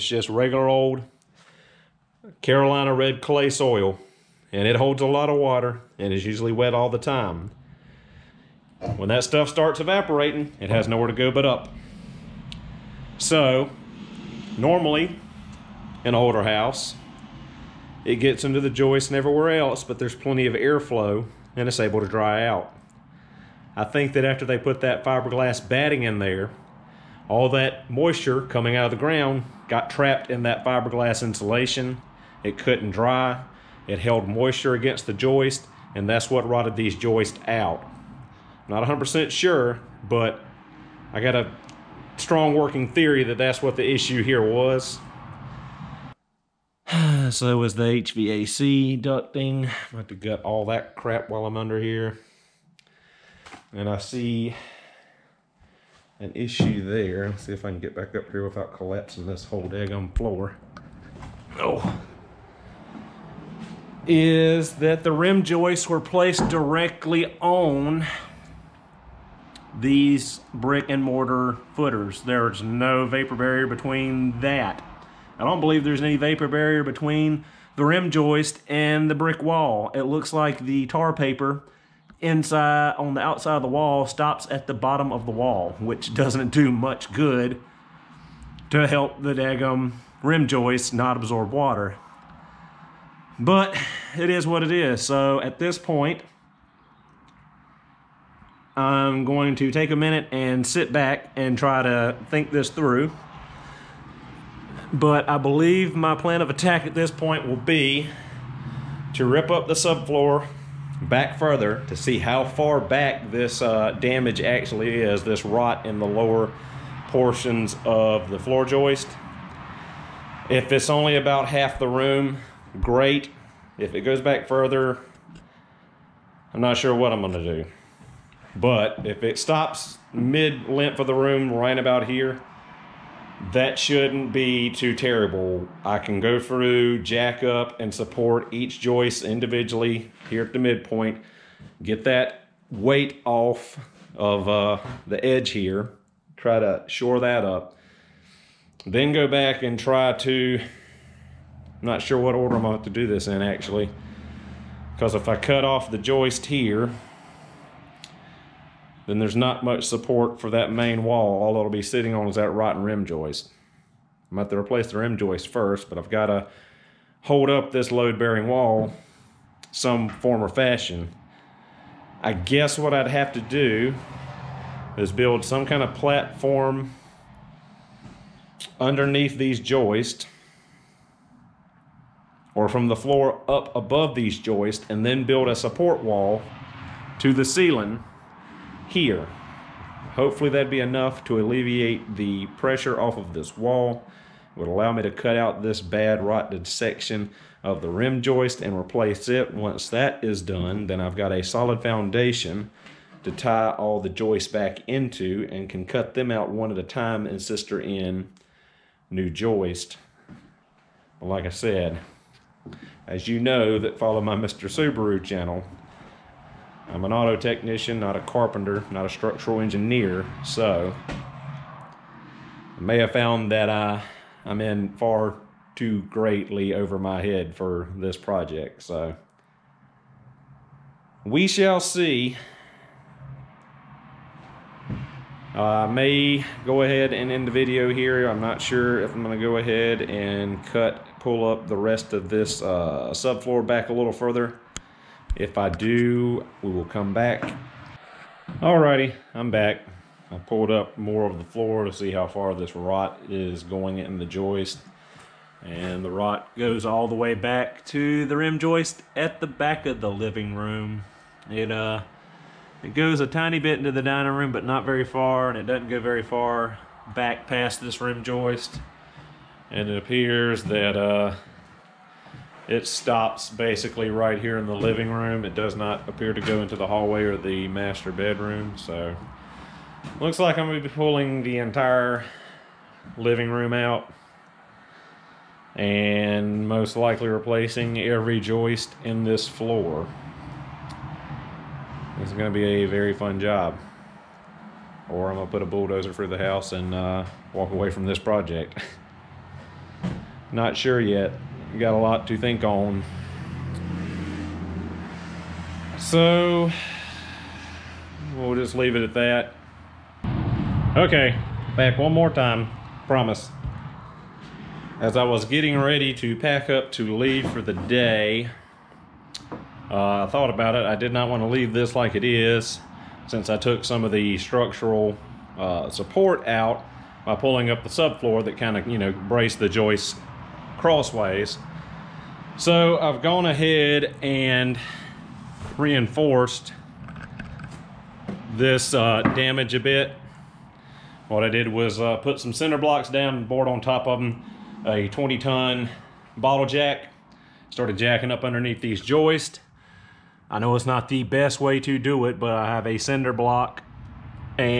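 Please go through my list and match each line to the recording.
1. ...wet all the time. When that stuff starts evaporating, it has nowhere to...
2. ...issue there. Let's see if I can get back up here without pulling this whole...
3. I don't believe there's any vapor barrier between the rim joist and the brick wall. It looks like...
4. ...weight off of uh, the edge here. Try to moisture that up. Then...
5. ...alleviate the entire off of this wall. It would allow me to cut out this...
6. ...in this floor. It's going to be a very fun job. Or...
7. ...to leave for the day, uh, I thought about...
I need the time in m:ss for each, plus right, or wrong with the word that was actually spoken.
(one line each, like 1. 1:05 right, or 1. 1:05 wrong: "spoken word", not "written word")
1. 0:06 right
2. 0:56 wrong: "collapsing", not "pulling"
3. 1:15 right
4. 2:22 wrong: "shore", not "moisture"
5. 3:11 wrong: "pressure", not "entire"
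6. 4:49 right
7. 5:16 right.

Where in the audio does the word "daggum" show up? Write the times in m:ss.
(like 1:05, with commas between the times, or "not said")
0:59, 1:29.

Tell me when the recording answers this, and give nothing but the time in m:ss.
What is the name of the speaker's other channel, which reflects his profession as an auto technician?
3:34.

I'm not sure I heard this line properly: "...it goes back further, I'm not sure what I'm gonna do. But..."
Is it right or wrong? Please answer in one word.
right.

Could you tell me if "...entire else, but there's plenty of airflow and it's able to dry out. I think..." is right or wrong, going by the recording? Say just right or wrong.
wrong.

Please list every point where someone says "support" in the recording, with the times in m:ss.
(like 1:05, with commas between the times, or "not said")
2:17, 2:39, 3:05, 5:25.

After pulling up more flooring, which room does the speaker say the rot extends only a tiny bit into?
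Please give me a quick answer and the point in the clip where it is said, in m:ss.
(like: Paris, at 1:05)
dining room, at 4:24.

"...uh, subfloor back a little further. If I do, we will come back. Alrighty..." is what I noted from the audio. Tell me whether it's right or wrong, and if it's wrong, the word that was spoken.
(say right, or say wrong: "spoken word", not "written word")
right.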